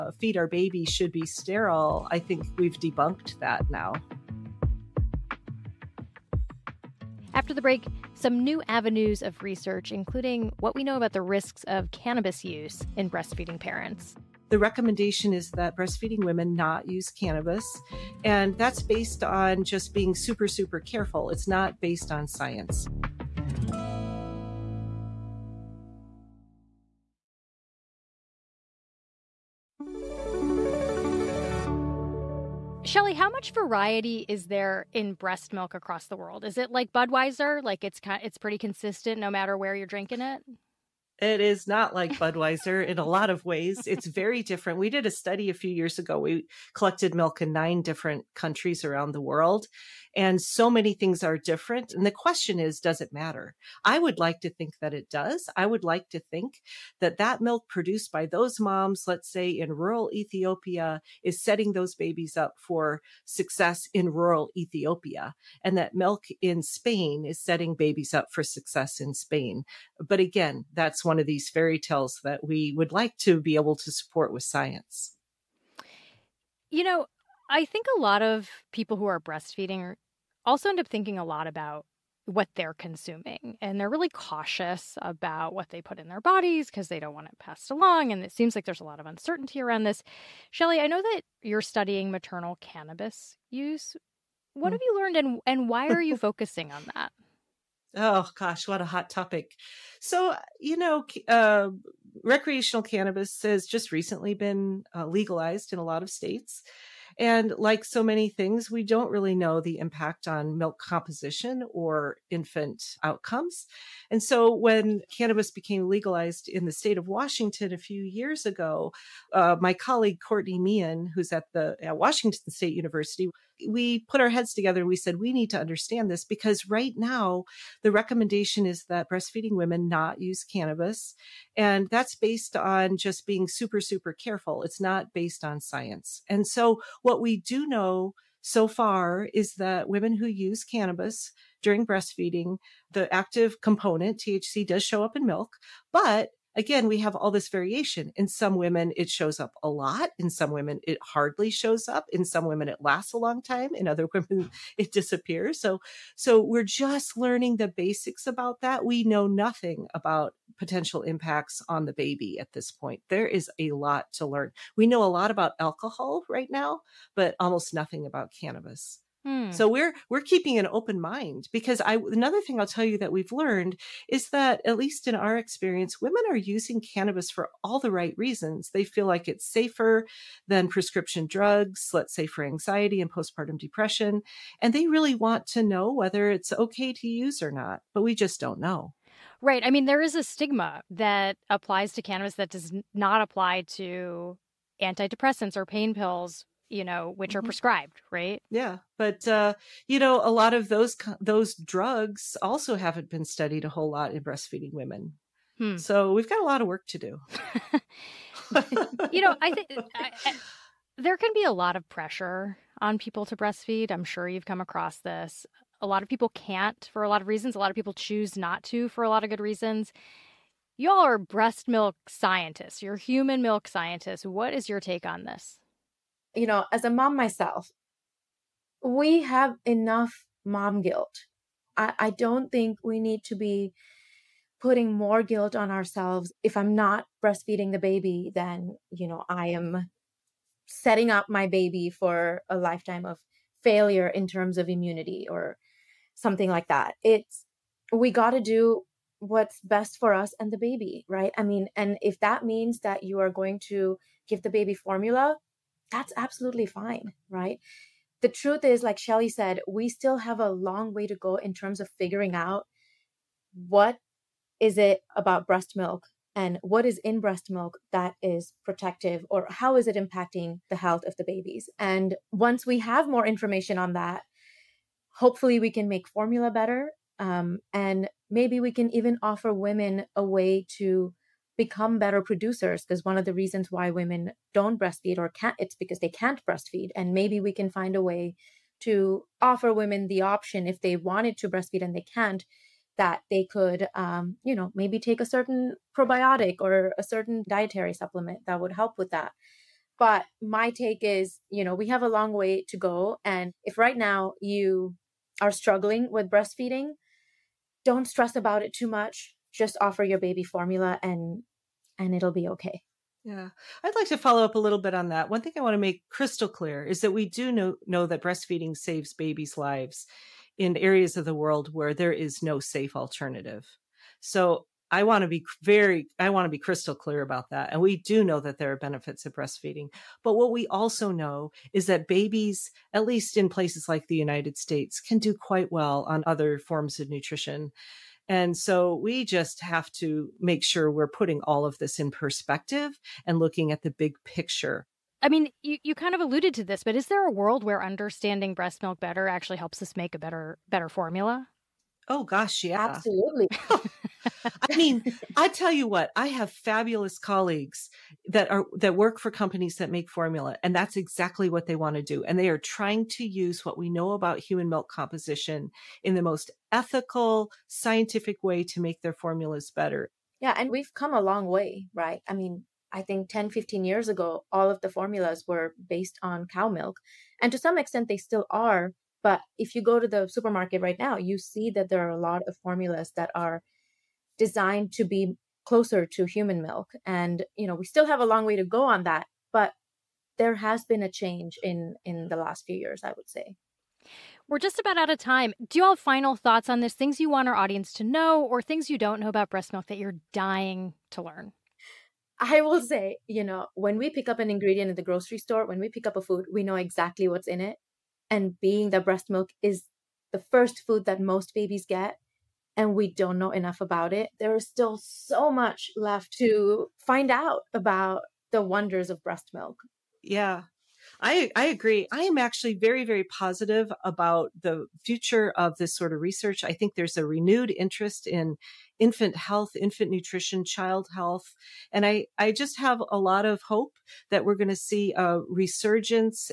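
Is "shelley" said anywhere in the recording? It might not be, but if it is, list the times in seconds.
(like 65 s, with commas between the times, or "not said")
32 s, 90 s, 258 s.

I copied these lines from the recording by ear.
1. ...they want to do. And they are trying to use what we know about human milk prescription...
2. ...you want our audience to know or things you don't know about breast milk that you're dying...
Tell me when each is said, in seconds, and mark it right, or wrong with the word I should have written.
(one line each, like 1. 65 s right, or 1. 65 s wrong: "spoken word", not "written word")
1. 361 s wrong: "composition", not "prescription"
2. 397 s right.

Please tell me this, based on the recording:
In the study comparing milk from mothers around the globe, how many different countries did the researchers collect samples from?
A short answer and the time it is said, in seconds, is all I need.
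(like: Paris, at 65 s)
9, at 47 s.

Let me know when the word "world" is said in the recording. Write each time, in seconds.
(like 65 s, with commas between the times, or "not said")
36 s, 49 s, 321 s, 347 s.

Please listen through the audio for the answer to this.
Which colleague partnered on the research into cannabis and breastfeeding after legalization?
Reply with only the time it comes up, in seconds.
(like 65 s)
120 s.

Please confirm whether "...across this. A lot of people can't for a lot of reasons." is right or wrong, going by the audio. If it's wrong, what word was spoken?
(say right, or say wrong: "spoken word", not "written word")
right.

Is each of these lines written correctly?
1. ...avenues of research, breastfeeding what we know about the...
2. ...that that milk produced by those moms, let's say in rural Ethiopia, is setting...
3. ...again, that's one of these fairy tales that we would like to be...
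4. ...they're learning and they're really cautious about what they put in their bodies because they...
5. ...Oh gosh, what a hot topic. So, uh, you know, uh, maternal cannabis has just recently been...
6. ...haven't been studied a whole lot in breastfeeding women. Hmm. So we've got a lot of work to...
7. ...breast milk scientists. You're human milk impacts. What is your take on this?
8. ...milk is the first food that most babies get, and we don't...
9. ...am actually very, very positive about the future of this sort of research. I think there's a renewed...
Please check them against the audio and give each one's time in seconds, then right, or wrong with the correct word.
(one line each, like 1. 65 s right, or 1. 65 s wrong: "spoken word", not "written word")
1. 8 s wrong: "including", not "breastfeeding"
2. 57 s right
3. 70 s right
4. 82 s wrong: "consuming", not "learning"
5. 97 s wrong: "recreational", not "maternal"
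6. 202 s right
7. 221 s wrong: "scientists", not "impacts"
8. 409 s right
9. 422 s right.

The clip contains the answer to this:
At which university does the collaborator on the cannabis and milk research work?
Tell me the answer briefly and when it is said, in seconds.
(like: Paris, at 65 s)
Washington State University, at 121 s.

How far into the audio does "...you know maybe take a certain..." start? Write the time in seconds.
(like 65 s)
294 s.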